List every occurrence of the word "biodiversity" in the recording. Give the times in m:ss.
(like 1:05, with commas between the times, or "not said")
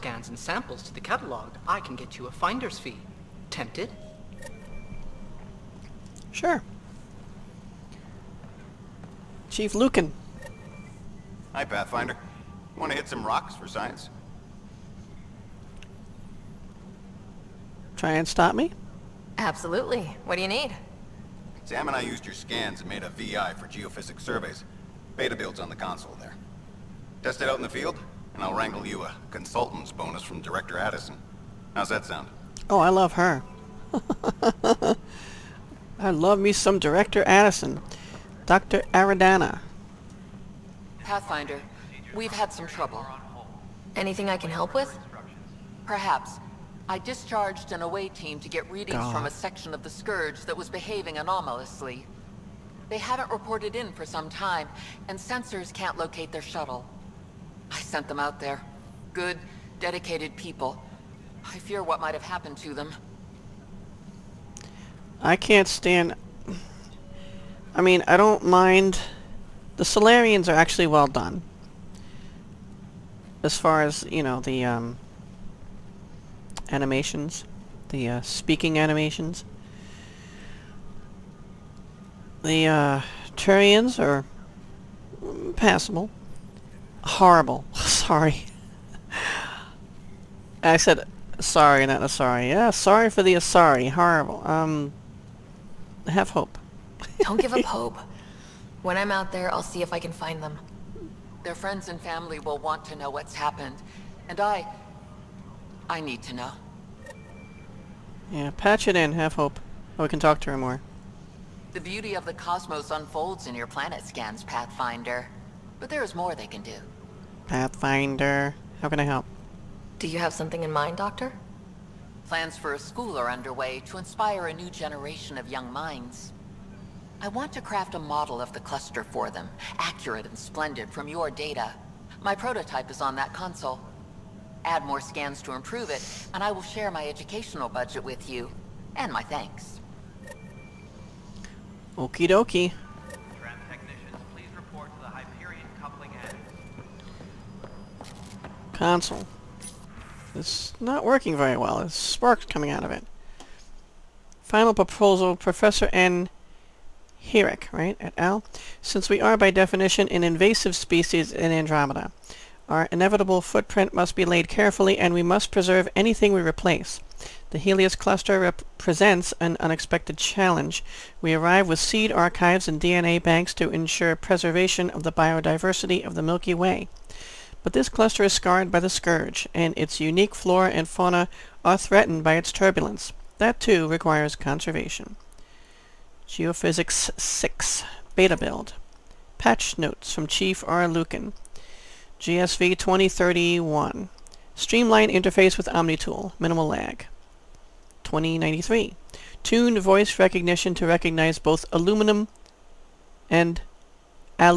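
2:55.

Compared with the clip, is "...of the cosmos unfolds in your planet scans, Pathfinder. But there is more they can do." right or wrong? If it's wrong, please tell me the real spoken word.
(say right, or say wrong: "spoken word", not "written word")
right.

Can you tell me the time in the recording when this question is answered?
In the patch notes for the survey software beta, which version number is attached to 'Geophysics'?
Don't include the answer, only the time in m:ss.
3:07.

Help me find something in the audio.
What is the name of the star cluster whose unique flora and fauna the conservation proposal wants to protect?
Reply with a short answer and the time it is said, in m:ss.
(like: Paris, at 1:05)
Helios, at 2:47.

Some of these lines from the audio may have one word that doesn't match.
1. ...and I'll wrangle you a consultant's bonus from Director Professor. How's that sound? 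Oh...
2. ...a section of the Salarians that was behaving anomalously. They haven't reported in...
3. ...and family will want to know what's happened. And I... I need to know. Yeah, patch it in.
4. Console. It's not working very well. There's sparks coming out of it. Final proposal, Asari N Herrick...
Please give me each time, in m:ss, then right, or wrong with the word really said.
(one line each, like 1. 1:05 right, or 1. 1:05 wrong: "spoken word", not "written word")
1. 0:28 wrong: "Addison", not "Professor"
2. 0:49 wrong: "Scourge", not "Salarians"
3. 1:41 right
4. 2:28 wrong: "Professor", not "Asari".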